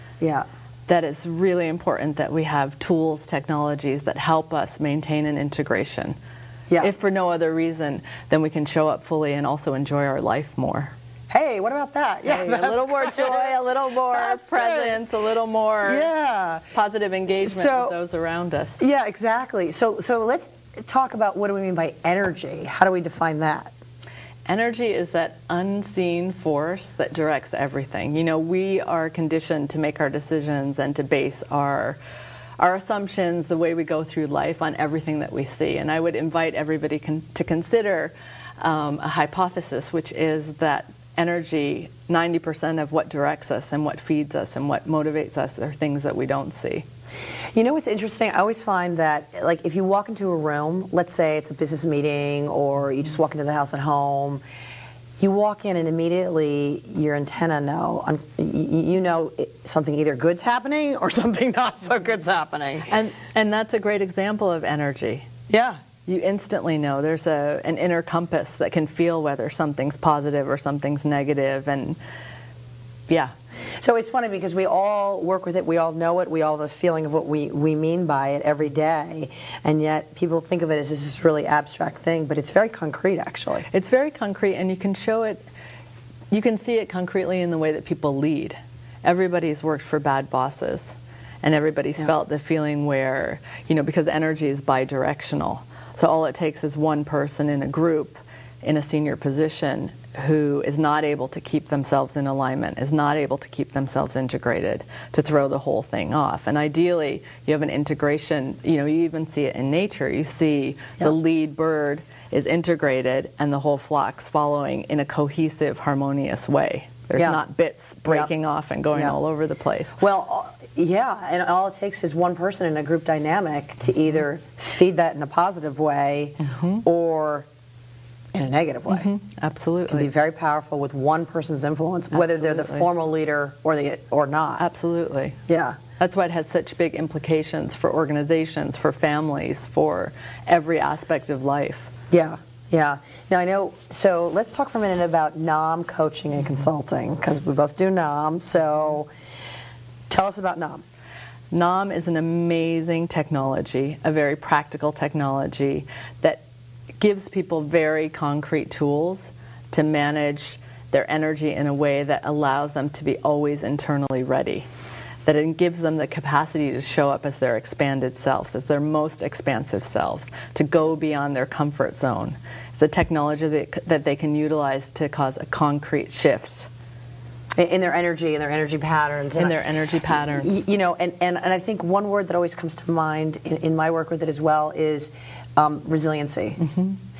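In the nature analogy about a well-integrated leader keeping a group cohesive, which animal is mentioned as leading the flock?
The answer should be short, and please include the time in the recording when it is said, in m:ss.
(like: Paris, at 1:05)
bird, at 1:51.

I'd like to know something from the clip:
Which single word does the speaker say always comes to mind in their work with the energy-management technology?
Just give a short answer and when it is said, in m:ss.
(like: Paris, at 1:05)
resiliency, at 3:05.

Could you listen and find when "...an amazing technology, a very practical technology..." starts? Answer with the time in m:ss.
2:32.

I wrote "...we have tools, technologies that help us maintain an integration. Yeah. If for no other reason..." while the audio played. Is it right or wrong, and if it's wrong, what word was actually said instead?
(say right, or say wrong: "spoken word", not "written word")
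right.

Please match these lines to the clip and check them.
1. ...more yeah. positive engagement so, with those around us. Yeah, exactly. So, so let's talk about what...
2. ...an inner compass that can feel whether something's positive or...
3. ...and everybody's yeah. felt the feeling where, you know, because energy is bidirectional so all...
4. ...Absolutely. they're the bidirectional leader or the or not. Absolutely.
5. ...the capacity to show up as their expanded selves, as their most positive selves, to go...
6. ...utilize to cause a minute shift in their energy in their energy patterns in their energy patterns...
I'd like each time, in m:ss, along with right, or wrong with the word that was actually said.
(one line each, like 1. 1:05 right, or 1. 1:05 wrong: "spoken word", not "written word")
1. 0:15 right
2. 1:07 right
3. 1:31 right
4. 2:12 wrong: "formal", not "bidirectional"
5. 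2:45 wrong: "expansive", not "positive"
6. 2:54 wrong: "concrete", not "minute".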